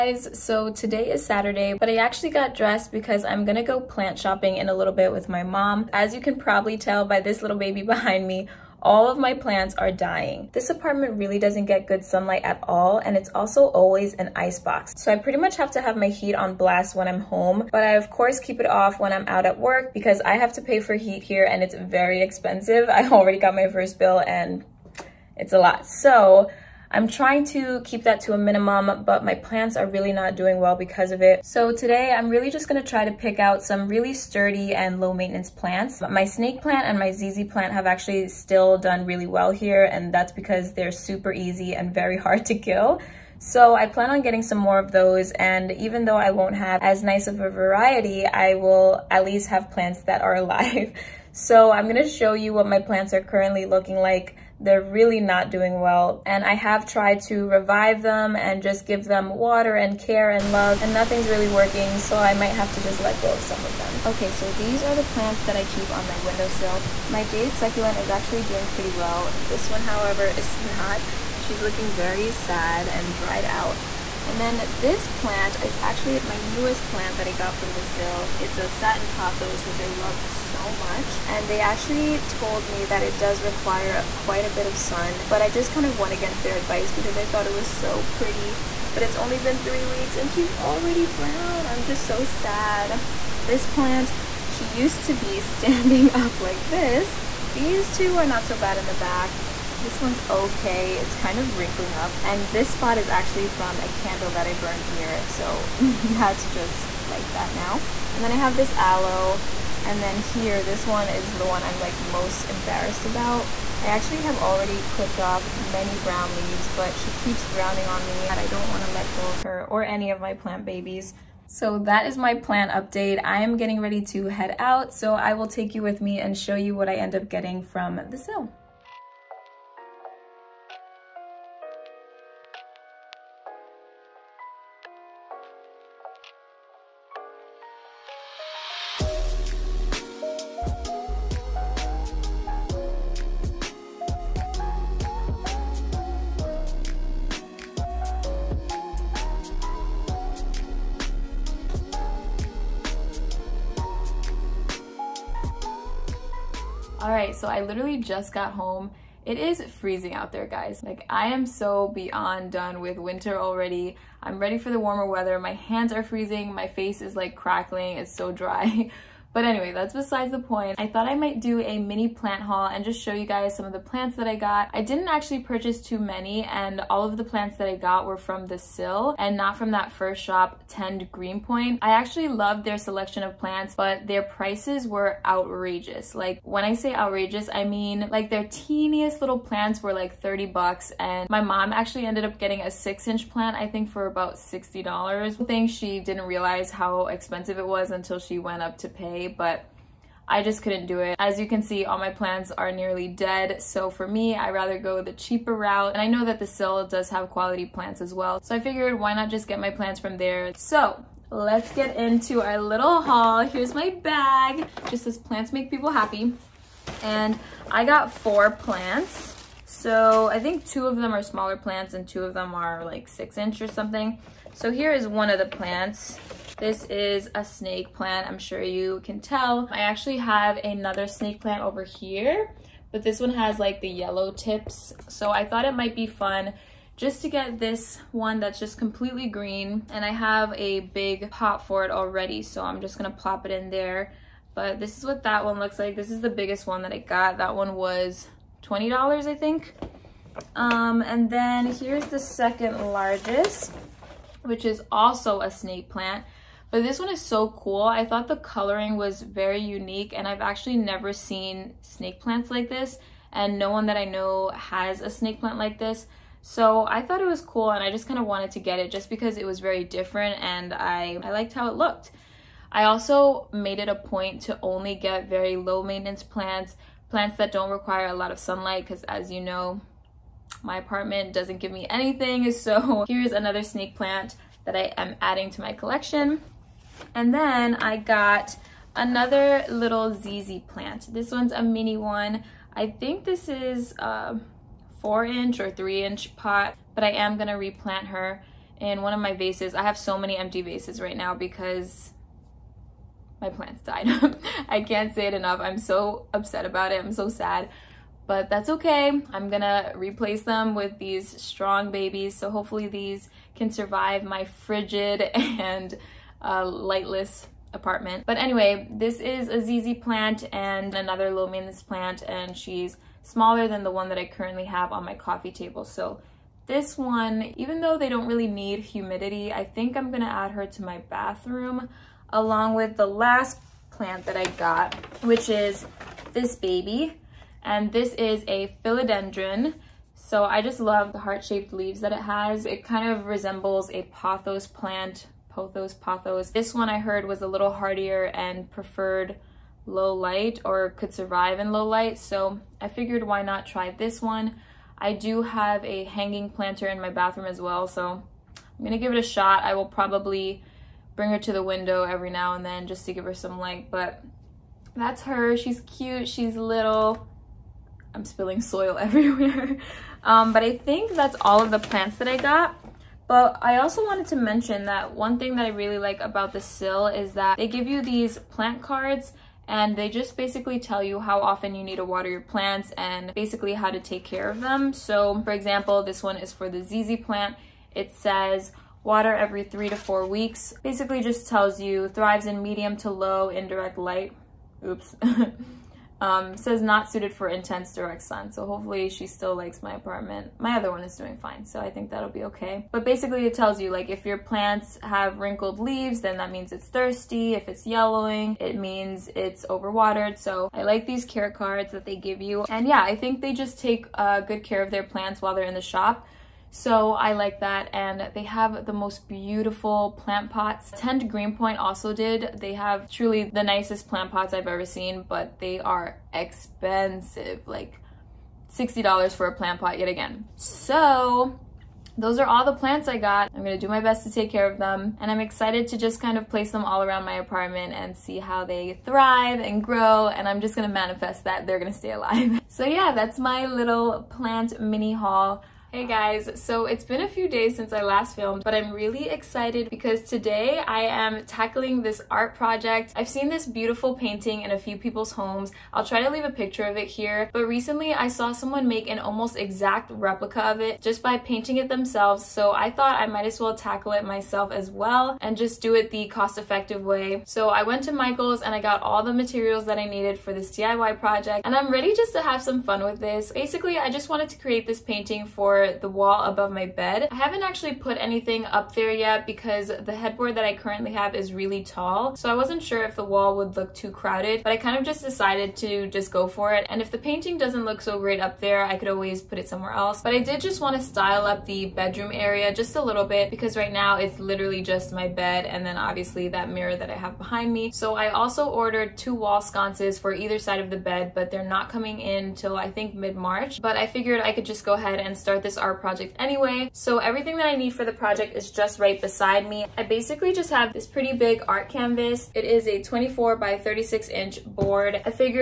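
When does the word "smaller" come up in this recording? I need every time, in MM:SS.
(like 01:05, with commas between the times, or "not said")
03:41, 05:23.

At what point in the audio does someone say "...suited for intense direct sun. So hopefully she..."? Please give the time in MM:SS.
06:37.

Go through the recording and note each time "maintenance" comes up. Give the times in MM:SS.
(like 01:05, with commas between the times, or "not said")
00:35, 04:35, 05:21.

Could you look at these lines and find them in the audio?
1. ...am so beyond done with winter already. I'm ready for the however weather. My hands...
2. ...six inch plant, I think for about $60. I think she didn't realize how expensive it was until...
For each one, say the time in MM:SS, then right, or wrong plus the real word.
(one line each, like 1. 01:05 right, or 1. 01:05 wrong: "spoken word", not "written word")
1. 02:41 wrong: "warmer", not "however"
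2. 03:12 right.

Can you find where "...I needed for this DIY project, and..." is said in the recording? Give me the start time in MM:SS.
07:49.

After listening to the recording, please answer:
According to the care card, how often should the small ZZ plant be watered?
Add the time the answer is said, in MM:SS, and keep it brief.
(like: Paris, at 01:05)
every 3 to 4 weeks, at 06:29.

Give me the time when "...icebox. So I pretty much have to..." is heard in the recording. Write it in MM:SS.
00:14.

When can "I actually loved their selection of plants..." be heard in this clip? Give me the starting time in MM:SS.
03:01.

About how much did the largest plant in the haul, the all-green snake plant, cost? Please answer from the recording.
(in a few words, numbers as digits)
$20.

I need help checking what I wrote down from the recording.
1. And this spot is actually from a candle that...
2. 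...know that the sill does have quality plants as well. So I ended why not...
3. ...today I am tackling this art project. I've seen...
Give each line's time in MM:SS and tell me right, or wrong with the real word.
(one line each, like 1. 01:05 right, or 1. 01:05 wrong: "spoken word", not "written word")
1. 01:42 right
2. 03:26 wrong: "figured", not "ended"
3. 07:30 right.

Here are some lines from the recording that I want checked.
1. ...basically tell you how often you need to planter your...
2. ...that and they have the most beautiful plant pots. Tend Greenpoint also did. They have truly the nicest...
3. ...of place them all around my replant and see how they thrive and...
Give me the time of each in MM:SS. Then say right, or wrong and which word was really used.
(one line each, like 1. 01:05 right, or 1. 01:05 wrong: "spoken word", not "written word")
1. 06:20 wrong: "water", not "planter"
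2. 06:57 right
3. 07:16 wrong: "apartment", not "replant".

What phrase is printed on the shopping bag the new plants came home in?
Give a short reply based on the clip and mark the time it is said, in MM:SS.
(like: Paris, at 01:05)
plants make people happy, at 03:35.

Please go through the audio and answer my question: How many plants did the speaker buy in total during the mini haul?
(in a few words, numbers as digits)
4.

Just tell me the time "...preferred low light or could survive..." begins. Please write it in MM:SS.
05:48.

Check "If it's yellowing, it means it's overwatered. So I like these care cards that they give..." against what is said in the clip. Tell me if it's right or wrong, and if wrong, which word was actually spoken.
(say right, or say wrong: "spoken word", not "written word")
right.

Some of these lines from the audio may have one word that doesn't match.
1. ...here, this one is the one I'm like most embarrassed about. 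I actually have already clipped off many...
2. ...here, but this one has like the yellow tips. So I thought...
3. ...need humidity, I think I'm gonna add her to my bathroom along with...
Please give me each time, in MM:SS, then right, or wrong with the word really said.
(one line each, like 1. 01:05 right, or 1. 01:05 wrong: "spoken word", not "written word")
1. 01:50 right
2. 03:51 right
3. 05:28 right.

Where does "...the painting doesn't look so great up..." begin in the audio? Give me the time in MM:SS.
08:07.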